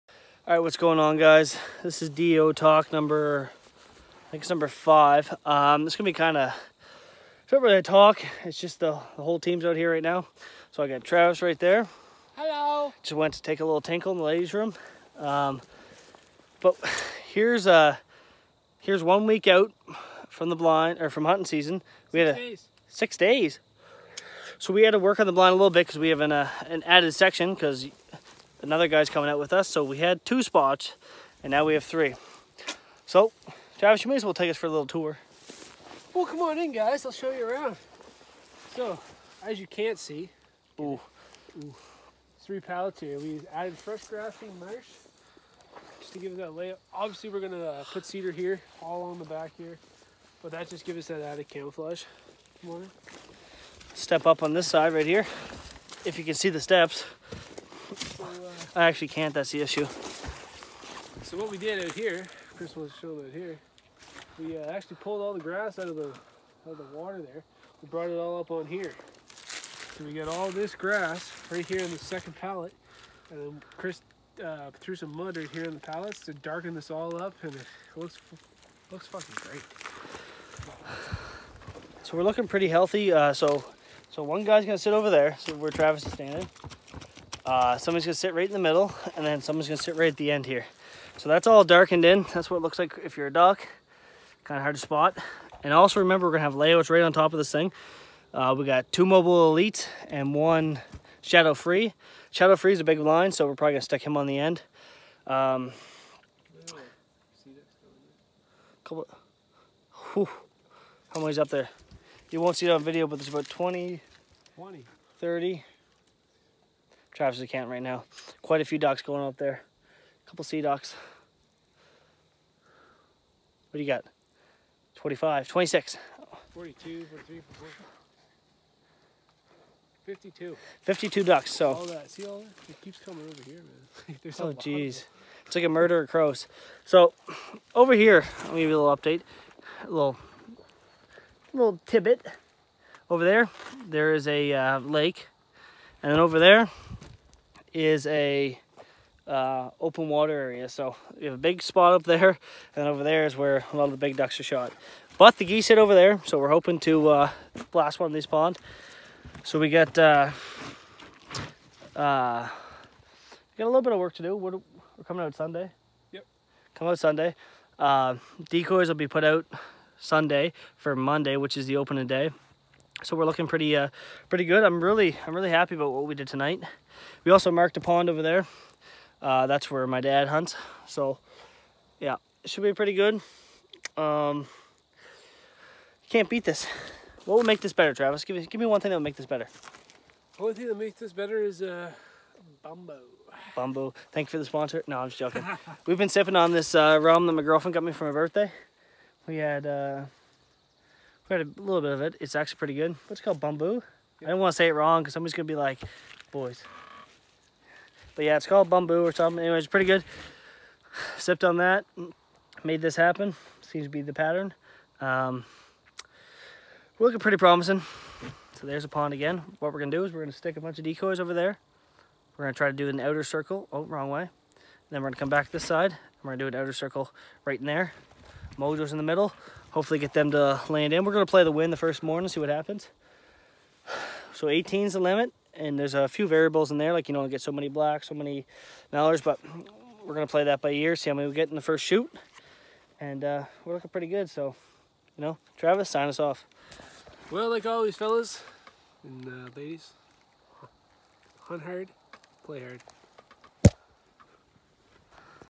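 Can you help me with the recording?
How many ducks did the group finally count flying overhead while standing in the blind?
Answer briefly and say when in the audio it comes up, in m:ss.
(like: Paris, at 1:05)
52, at 2:10.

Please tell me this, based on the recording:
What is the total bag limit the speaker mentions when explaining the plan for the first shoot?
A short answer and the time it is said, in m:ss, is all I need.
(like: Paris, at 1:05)
18, at 3:54.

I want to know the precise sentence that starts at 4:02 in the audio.
And uh, we're looking pretty good, so, you know, Travis, sign us off.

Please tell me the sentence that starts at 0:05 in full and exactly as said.
Um, it's gonna be kind of, it's not really a talk.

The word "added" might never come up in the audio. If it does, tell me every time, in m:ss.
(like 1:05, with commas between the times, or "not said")
0:26, 0:43, 0:51.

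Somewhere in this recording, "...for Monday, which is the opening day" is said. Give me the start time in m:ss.
2:50.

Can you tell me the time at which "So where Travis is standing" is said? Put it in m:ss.
1:25.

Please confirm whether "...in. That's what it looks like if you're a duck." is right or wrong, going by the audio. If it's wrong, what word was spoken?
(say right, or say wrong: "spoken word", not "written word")
right.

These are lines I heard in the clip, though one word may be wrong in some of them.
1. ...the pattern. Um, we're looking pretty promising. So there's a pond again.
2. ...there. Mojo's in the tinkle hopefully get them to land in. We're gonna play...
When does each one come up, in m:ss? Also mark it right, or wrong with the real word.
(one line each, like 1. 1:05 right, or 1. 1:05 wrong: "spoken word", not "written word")
1. 3:34 right
2. 3:47 wrong: "middle", not "tinkle".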